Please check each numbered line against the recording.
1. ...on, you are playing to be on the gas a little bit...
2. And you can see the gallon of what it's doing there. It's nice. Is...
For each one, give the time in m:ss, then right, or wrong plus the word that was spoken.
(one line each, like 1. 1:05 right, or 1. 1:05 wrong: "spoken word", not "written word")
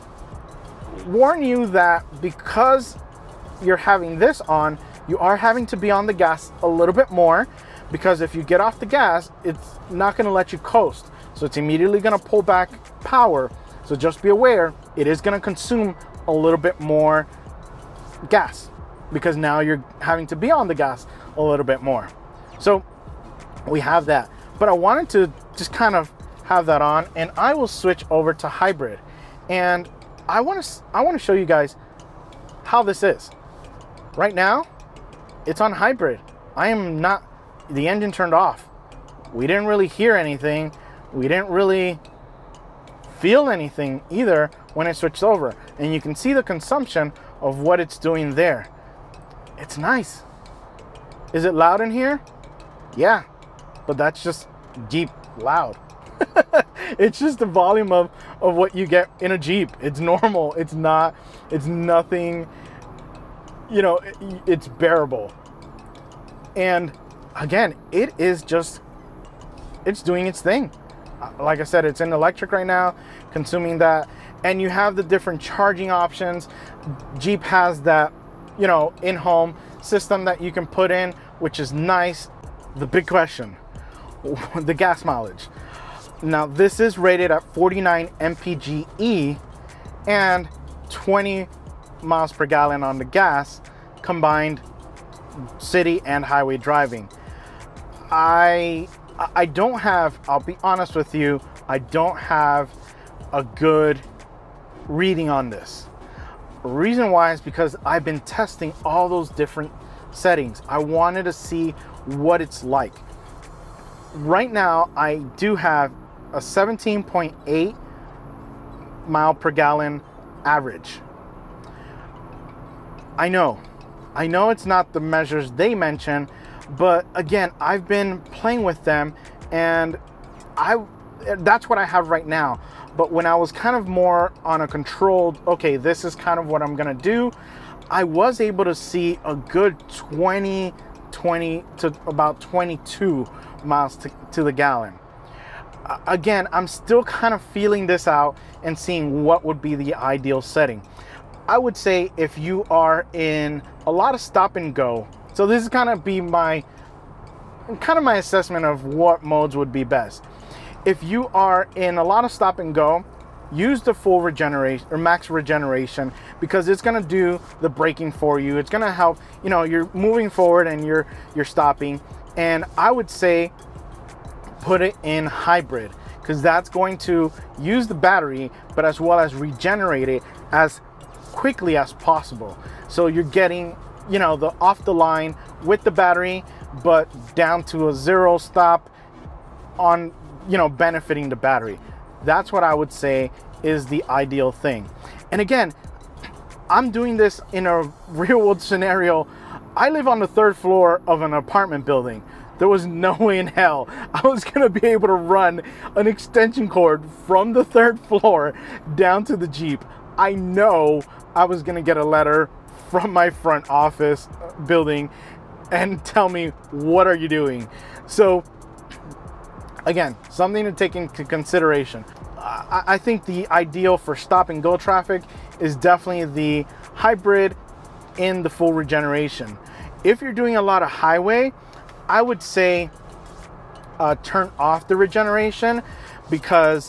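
1. 0:04 wrong: "having", not "playing"
2. 0:45 wrong: "consumption", not "gallon".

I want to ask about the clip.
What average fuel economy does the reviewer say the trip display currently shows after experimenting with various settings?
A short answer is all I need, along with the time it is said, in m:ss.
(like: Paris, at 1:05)
17.8 mpg, at 1:56.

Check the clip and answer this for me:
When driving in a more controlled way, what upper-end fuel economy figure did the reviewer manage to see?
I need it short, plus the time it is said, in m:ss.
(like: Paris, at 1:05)
22 mpg, at 2:22.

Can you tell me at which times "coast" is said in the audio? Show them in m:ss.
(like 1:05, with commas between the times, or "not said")
0:10.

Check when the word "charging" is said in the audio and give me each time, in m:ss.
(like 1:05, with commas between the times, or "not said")
1:15.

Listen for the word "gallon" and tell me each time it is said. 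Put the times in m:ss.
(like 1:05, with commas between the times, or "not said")
1:32, 1:59, 2:24.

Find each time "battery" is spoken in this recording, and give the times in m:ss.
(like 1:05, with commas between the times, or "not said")
2:57, 3:05, 3:11.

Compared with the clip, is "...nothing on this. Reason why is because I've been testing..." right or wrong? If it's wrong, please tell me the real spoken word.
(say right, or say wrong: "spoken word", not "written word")
wrong: "reading", not "nothing".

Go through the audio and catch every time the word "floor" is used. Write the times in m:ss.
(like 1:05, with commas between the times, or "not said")
3:20, 3:28.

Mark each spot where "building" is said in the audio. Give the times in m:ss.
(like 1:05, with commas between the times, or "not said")
3:21, 3:34.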